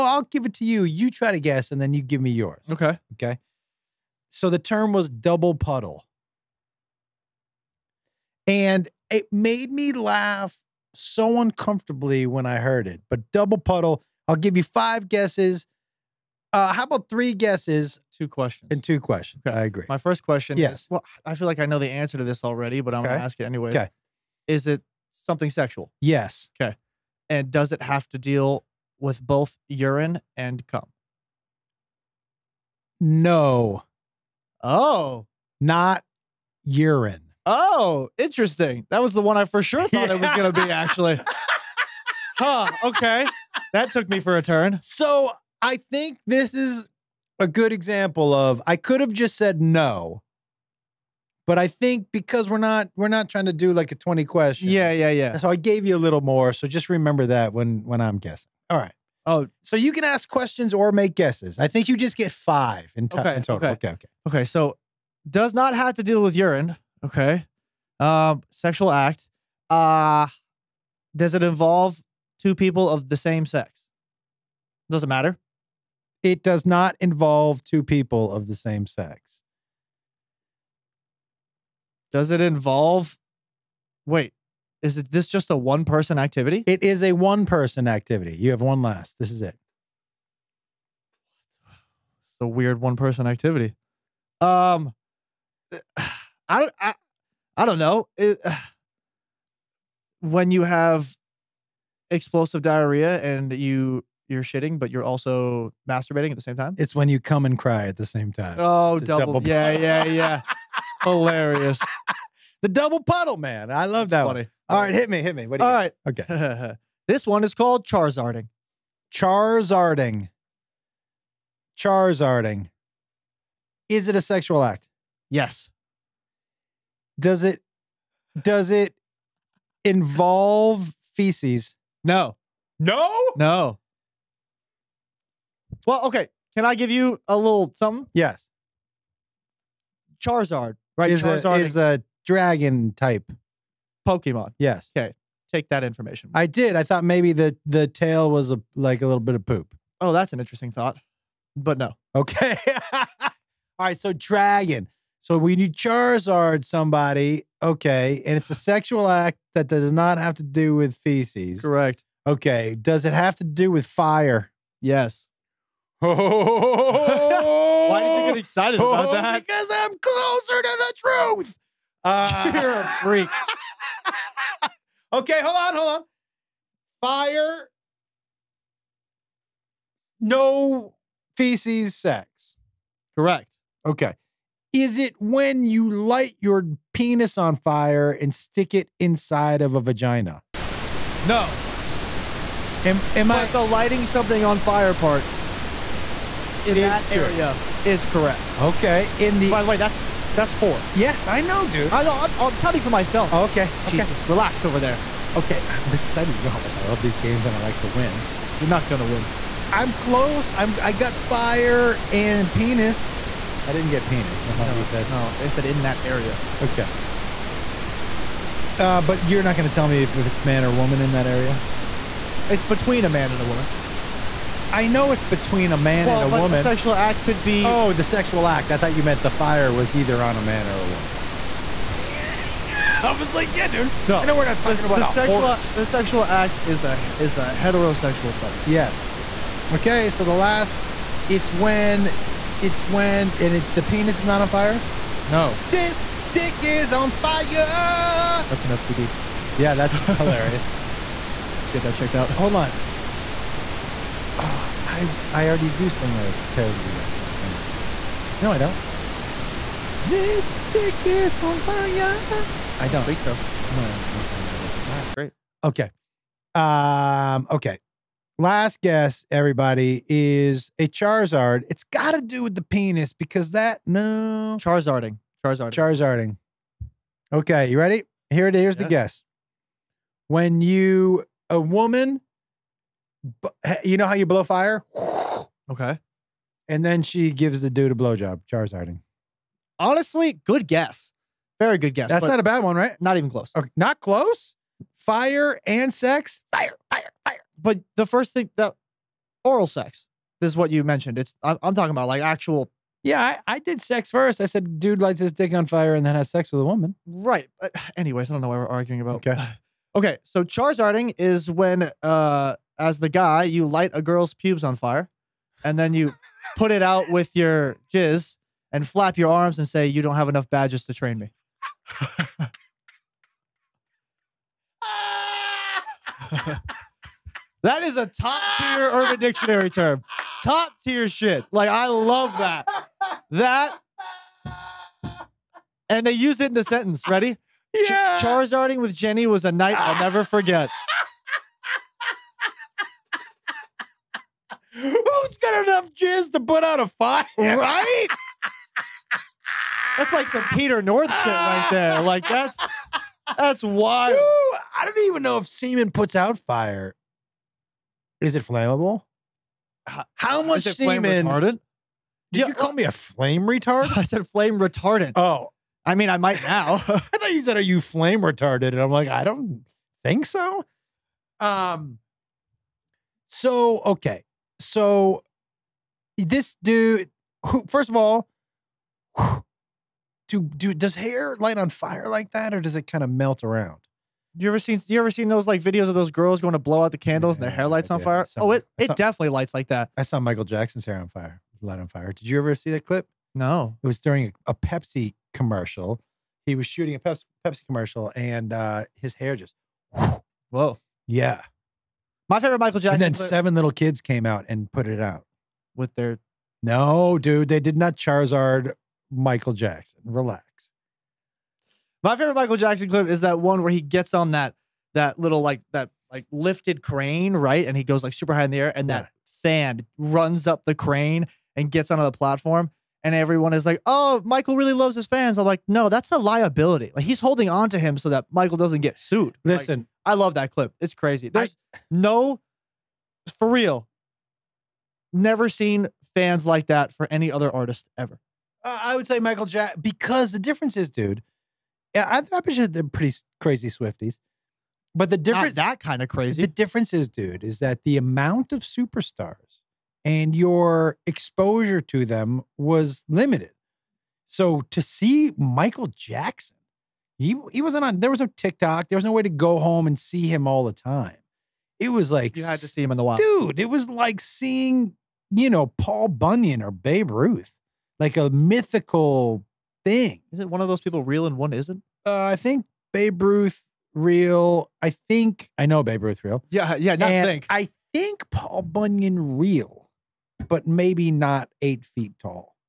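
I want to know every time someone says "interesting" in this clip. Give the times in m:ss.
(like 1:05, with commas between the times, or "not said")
0:38, 2:30.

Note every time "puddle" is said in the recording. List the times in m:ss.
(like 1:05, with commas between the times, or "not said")
0:05, 0:13, 1:53.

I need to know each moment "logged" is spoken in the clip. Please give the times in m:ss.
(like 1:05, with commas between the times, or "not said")
not said.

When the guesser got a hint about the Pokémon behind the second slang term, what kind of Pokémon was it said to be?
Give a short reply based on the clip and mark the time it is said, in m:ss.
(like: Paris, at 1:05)
Dragon type, at 2:22.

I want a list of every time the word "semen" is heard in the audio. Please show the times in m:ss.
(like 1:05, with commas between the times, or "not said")
5:55, 6:00.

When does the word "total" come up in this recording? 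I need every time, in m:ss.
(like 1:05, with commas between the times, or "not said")
1:03.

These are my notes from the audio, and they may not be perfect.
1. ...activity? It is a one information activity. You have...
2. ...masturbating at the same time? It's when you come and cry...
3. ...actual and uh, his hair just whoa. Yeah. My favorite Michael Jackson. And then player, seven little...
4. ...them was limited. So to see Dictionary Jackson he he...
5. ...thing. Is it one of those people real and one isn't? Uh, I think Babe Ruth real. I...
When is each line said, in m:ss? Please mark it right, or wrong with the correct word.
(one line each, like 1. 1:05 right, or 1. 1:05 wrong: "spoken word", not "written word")
1. 1:26 wrong: "person", not "information"
2. 1:45 right
3. 6:37 wrong: "commercial", not "actual"
4. 7:32 wrong: "Michael", not "Dictionary"
5. 7:49 right.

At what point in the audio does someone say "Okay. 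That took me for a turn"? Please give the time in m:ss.
0:42.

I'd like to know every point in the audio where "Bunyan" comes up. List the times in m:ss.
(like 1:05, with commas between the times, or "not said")
7:46, 7:58.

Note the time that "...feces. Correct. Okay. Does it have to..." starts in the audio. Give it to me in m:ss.
2:40.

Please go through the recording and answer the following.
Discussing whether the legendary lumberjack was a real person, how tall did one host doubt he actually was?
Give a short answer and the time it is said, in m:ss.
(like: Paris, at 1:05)
8 feet tall, at 8:01.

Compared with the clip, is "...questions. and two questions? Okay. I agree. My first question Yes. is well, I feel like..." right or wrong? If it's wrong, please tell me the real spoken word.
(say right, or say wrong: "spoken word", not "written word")
right.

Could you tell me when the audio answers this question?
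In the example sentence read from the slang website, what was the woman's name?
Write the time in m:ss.
5:38.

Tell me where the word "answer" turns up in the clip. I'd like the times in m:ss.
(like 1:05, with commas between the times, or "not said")
0:21.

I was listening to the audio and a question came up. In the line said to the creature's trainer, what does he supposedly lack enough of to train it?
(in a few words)
Badges.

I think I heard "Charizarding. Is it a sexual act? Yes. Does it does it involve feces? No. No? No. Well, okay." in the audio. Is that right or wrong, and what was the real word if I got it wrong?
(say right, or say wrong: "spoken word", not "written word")
right.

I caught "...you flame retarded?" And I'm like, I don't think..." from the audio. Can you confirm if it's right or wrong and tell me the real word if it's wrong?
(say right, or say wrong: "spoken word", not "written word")
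right.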